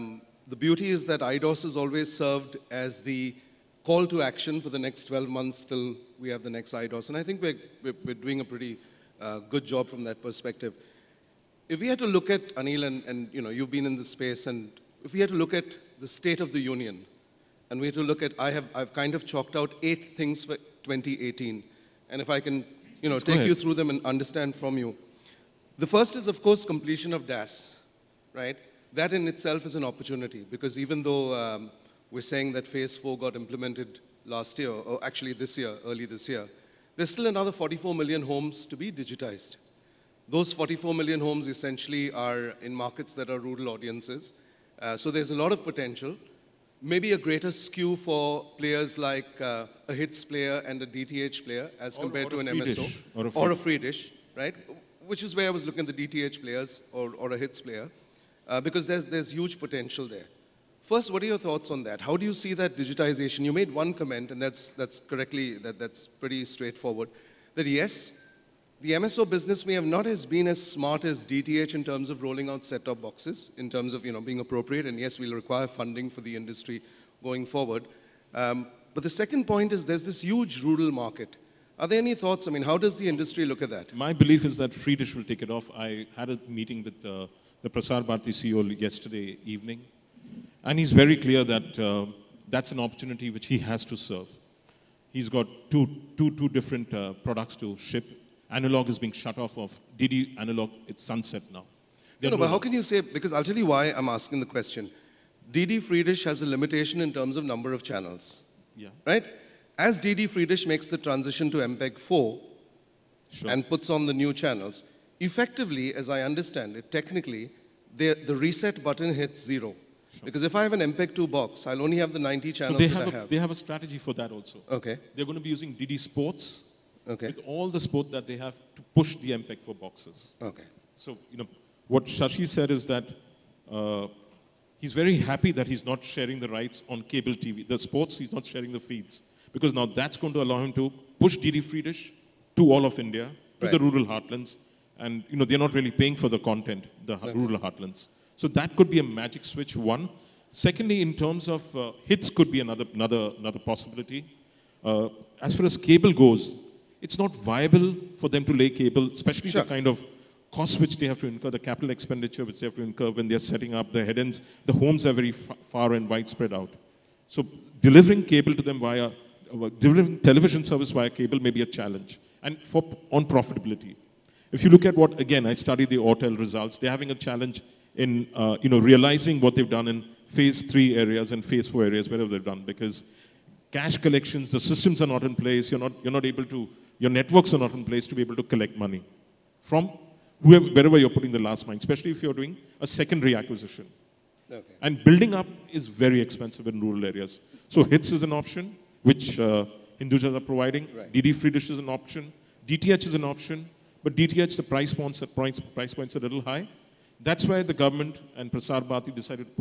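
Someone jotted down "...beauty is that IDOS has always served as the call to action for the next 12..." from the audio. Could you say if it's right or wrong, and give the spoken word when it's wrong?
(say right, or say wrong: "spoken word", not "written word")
right.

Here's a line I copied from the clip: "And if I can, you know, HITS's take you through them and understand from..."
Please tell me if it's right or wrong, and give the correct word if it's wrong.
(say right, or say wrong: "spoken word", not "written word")
wrong: "Let", not "HITS".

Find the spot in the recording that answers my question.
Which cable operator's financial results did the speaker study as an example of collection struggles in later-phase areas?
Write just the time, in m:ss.
2:55.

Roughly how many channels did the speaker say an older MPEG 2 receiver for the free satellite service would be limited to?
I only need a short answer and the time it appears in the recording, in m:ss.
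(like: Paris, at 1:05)
90, at 2:02.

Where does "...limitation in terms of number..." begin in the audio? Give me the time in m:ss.
1:46.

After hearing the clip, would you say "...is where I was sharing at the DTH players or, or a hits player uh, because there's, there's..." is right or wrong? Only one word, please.
wrong.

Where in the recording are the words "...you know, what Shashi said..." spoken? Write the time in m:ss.
2:11.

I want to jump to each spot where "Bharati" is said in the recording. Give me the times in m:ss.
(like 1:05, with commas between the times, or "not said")
1:28, 3:28.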